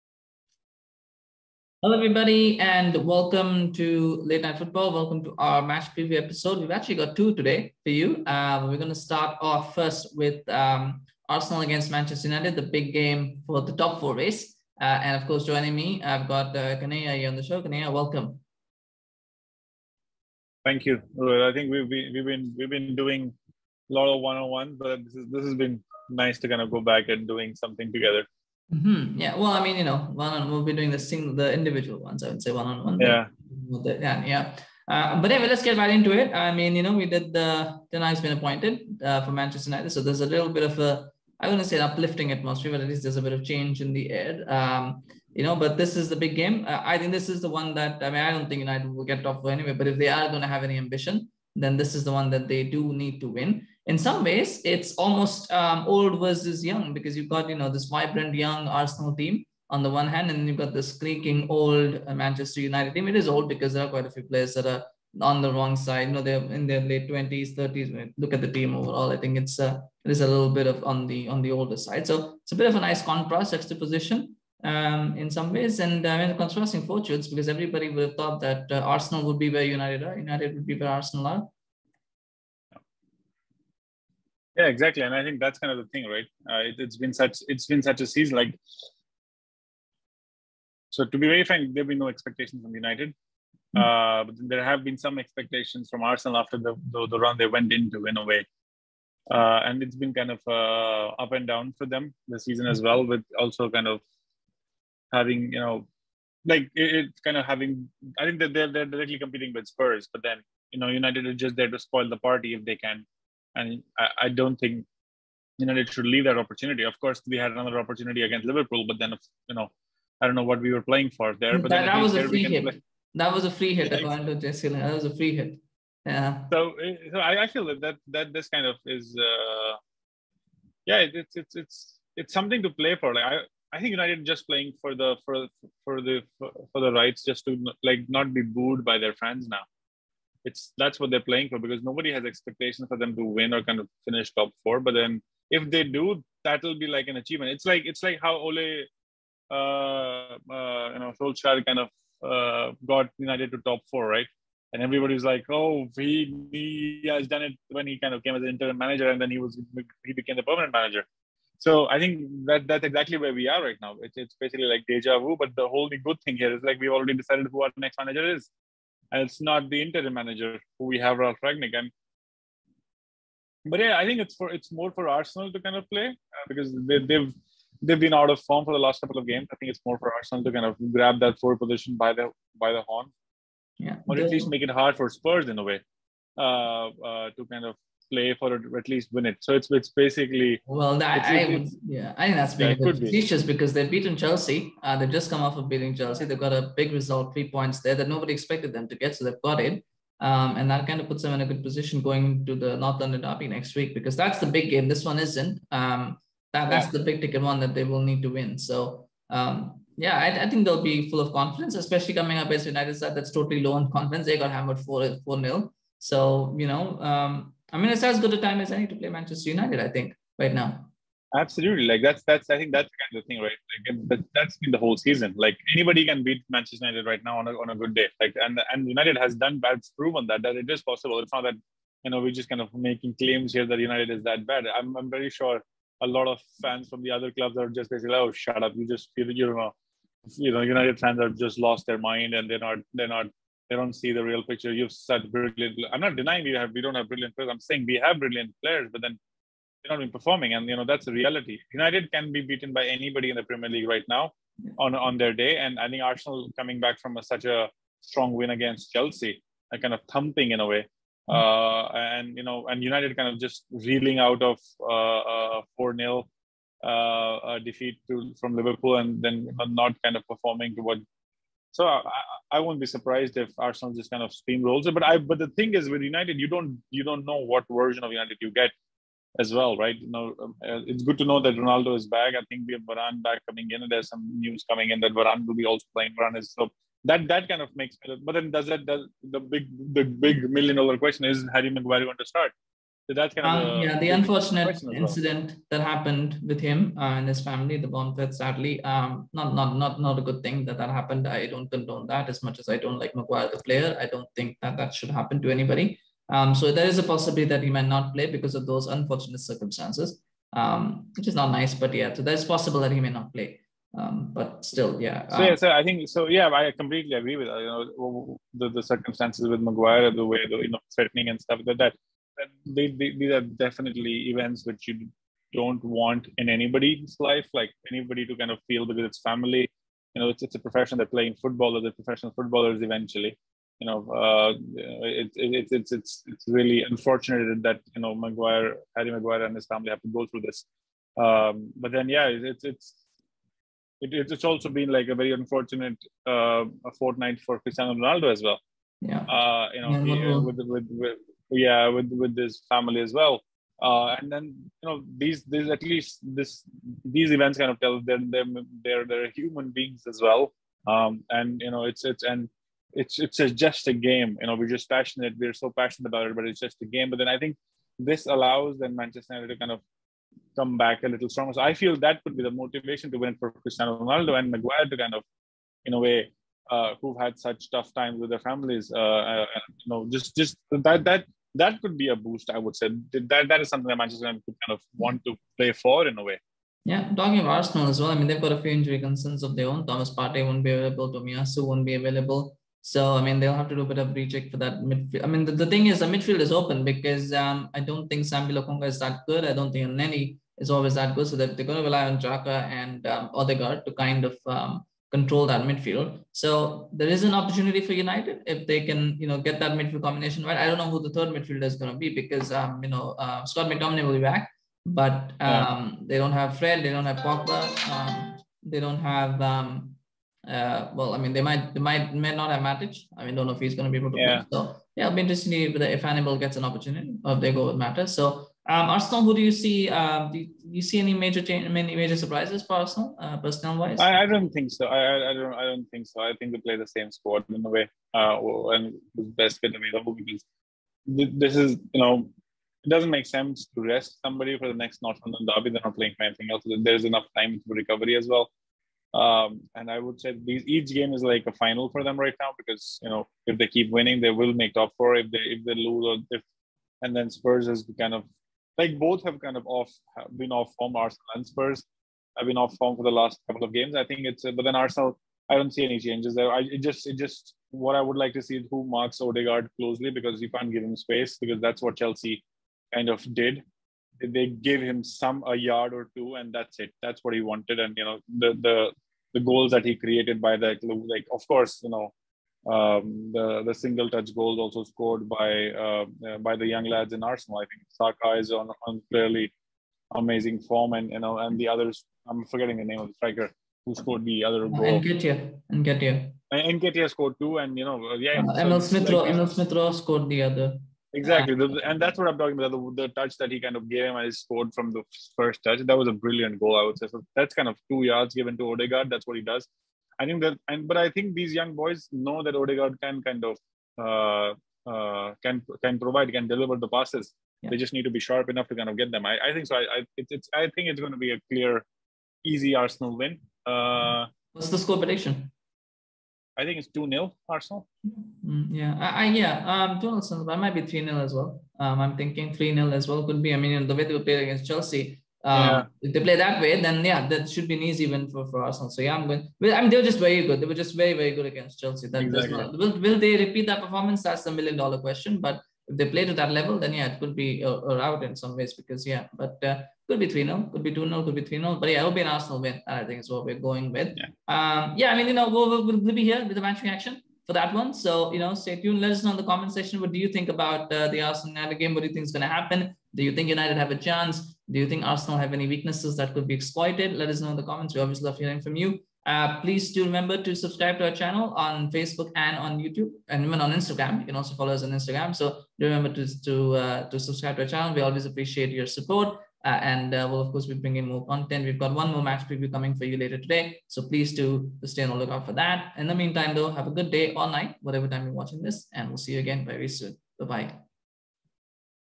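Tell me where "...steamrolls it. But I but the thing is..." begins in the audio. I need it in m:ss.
4:34.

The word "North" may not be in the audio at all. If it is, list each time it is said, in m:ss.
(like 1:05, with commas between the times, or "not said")
3:22, 7:25.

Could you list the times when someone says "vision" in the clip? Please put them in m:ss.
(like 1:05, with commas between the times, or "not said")
not said.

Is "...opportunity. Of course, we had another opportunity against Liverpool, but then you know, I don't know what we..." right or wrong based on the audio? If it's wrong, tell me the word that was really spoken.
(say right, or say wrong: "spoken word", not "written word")
right.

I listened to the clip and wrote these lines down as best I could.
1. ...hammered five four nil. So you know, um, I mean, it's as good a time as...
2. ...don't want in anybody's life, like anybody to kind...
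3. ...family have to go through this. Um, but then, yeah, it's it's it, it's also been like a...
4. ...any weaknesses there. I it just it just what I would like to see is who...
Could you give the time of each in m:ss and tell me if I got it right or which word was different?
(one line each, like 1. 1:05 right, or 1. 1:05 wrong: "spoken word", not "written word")
1. 3:34 wrong: "four", not "five"
2. 5:25 right
3. 5:39 right
4. 7:45 wrong: "changes", not "weaknesses".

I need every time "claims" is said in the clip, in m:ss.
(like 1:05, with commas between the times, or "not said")
3:53.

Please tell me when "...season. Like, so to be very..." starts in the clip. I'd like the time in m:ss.
1:28.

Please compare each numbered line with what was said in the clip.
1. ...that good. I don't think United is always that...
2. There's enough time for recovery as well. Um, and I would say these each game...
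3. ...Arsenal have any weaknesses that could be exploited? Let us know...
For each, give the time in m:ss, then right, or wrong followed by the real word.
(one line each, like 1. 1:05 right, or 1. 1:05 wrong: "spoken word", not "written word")
1. 6:38 wrong: "Nenny", not "United"
2. 7:26 right
3. 9:25 right.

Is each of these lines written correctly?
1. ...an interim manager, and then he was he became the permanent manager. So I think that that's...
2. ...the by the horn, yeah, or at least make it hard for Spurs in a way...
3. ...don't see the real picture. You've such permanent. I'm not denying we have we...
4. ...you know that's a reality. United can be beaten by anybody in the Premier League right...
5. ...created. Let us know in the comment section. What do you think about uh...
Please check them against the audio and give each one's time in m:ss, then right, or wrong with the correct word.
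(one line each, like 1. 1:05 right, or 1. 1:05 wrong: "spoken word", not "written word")
1. 2:38 right
2. 3:02 right
3. 4:03 wrong: "brilliant", not "permanent"
4. 4:10 right
5. 9:18 wrong: "tuned", not "created".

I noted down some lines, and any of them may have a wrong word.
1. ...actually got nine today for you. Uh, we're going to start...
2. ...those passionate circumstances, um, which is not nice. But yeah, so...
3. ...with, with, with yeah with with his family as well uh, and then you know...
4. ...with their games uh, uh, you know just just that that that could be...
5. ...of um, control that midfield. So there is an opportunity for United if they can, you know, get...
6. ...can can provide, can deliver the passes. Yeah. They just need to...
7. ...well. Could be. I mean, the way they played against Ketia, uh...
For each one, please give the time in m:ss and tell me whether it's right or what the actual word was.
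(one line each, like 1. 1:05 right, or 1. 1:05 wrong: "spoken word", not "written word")
1. 0:06 wrong: "two", not "nine"
2. 5:08 wrong: "unfortunate", not "passionate"
3. 5:50 right
4. 6:18 wrong: "families", not "games"
5. 6:44 right
6. 8:35 right
7. 8:53 wrong: "Chelsea", not "Ketia".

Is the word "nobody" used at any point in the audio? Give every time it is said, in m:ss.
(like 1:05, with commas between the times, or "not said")
2:21, 3:18.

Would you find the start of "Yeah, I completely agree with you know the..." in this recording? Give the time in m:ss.
5:16.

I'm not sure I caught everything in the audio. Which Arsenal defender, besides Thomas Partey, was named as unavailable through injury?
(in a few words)
Tomiyasu.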